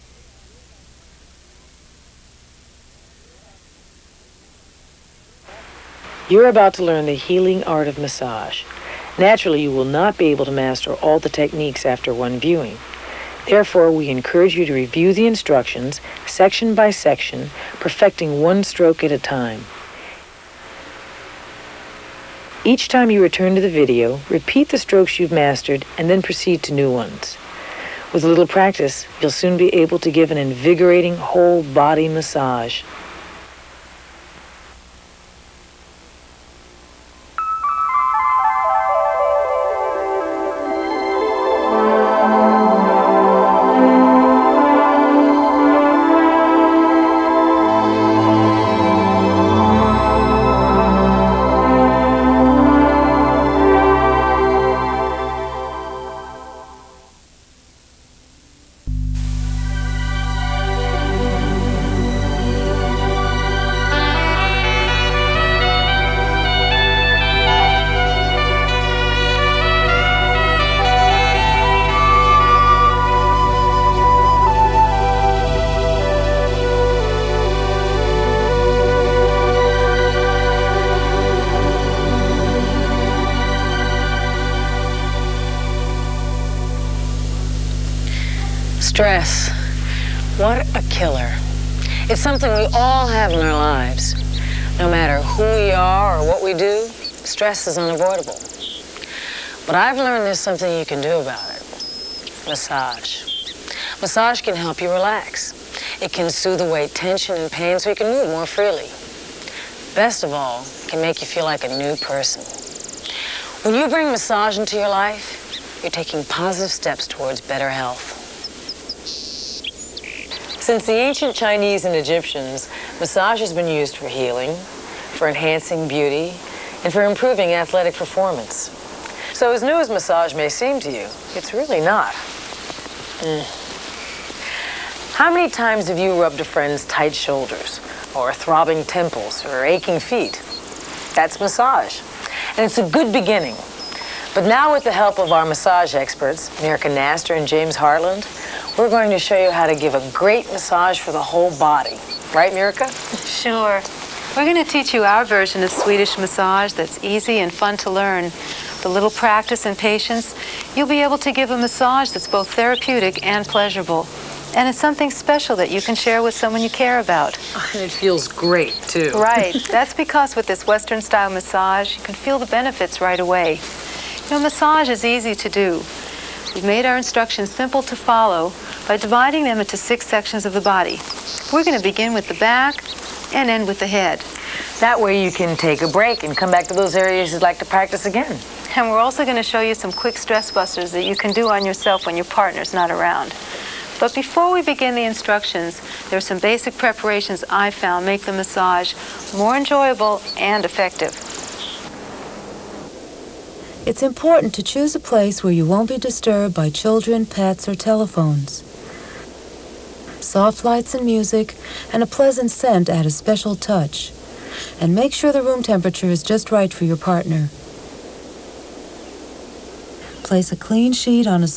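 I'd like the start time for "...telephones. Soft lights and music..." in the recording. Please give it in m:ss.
3:27.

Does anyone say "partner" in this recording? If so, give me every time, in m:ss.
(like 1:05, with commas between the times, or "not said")
3:12, 3:36.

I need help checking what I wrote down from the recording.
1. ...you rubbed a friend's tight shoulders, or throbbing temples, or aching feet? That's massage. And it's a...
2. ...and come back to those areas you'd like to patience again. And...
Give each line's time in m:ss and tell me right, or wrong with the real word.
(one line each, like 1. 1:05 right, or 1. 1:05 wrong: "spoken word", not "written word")
1. 2:15 right
2. 3:06 wrong: "practice", not "patience".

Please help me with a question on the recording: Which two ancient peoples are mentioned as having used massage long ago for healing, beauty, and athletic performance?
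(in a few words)
Chinese and Egyptians.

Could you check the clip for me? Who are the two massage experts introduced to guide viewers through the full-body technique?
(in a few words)
Mirka Knaster and James Heartland.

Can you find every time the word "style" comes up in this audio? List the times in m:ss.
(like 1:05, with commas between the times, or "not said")
2:50.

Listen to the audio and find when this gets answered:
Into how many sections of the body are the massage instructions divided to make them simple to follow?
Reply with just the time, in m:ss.
2:59.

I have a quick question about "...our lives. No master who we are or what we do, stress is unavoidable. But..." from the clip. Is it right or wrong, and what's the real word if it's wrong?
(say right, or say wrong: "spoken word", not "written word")
wrong: "matter", not "master".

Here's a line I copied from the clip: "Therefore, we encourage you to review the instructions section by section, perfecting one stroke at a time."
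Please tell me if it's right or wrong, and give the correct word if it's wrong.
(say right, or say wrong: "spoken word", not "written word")
right.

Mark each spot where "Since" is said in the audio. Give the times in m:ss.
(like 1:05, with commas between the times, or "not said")
2:00.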